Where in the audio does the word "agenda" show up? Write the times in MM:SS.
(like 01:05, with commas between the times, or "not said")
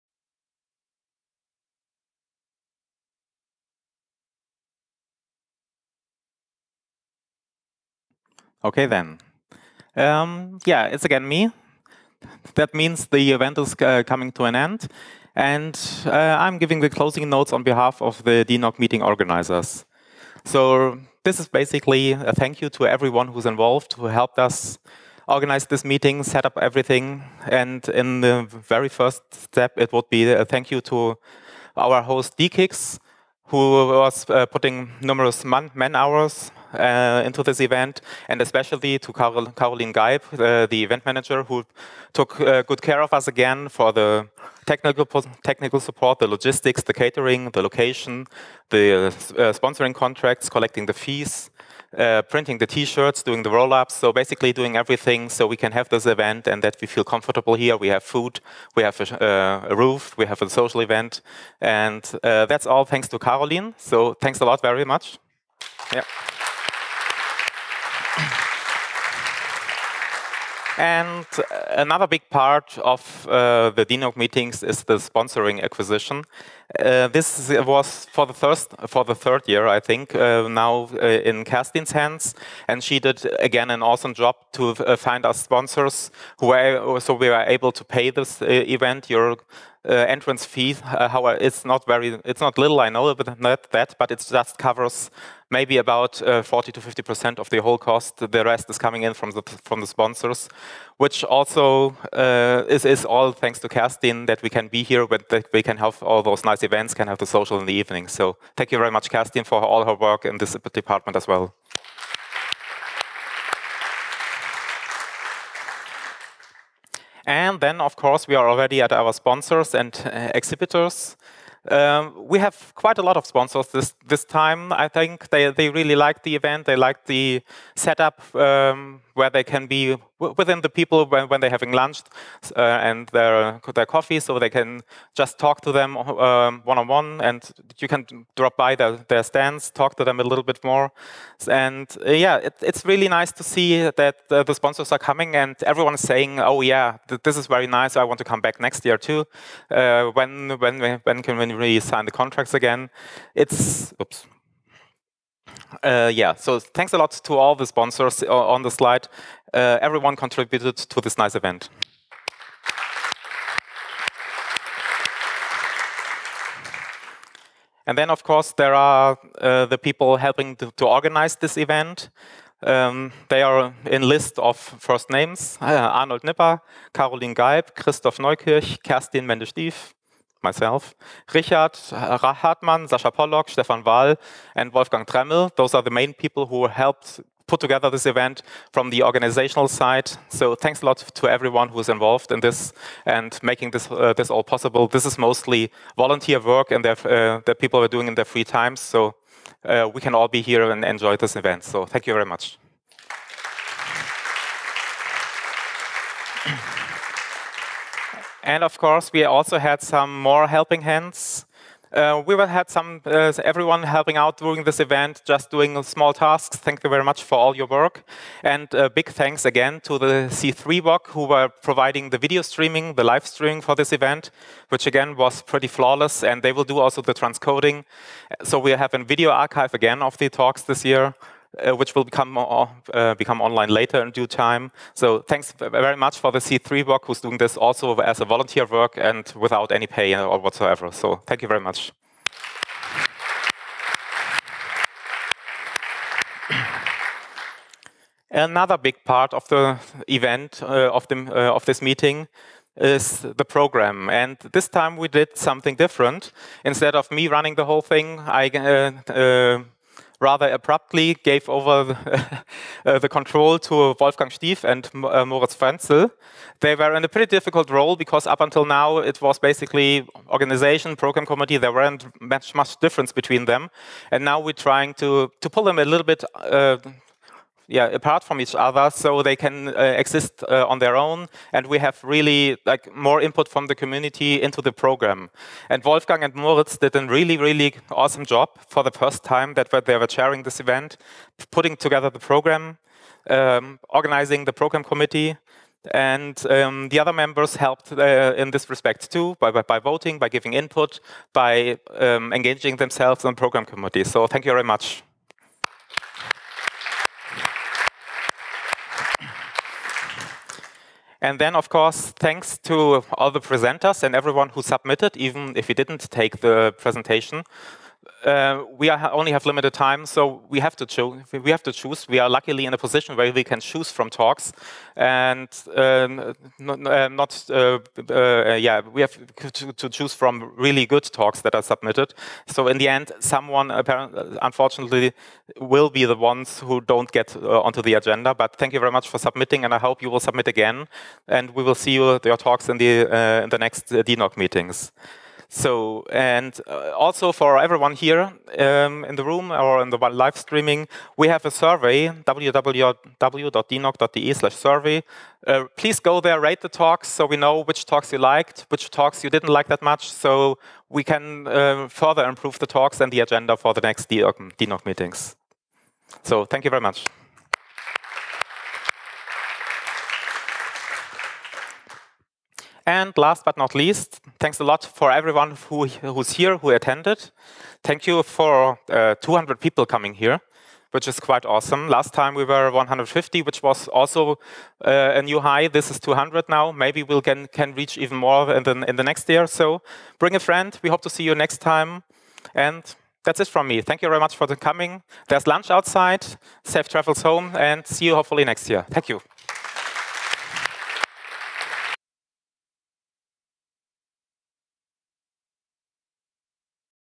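05:37, 06:03.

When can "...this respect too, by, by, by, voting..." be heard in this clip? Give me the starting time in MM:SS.
04:58.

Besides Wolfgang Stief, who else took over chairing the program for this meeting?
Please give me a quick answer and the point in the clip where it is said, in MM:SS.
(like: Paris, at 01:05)
Moritz Frenzel, at 04:25.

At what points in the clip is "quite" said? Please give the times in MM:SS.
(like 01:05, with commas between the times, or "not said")
02:02, 06:21.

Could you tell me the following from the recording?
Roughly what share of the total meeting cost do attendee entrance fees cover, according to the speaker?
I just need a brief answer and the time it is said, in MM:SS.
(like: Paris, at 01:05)
40 to 50 percent, at 01:36.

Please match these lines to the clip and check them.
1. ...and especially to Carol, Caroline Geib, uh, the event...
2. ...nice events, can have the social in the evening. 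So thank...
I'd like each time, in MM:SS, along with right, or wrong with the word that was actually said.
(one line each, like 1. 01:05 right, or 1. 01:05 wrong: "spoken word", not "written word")
1. 00:38 right
2. 01:46 right.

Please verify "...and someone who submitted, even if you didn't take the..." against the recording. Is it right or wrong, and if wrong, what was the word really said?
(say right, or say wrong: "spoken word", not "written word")
wrong: "everyone", not "someone".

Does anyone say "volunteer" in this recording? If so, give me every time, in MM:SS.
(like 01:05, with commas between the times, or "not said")
03:15, 03:58.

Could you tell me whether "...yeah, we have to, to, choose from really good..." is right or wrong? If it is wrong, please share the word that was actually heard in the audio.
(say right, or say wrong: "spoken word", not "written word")
right.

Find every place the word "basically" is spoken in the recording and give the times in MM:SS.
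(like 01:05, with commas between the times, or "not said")
00:21, 00:54, 04:29.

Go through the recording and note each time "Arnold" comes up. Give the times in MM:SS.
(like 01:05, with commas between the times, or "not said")
02:55.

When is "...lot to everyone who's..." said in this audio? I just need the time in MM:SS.
03:10.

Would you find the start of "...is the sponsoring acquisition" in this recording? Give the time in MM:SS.
01:14.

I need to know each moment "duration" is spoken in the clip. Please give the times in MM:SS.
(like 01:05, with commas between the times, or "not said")
not said.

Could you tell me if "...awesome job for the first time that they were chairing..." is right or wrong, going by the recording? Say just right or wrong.
right.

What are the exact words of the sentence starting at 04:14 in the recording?
And this time we did something different.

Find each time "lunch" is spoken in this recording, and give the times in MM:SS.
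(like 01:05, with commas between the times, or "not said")
02:11, 06:35.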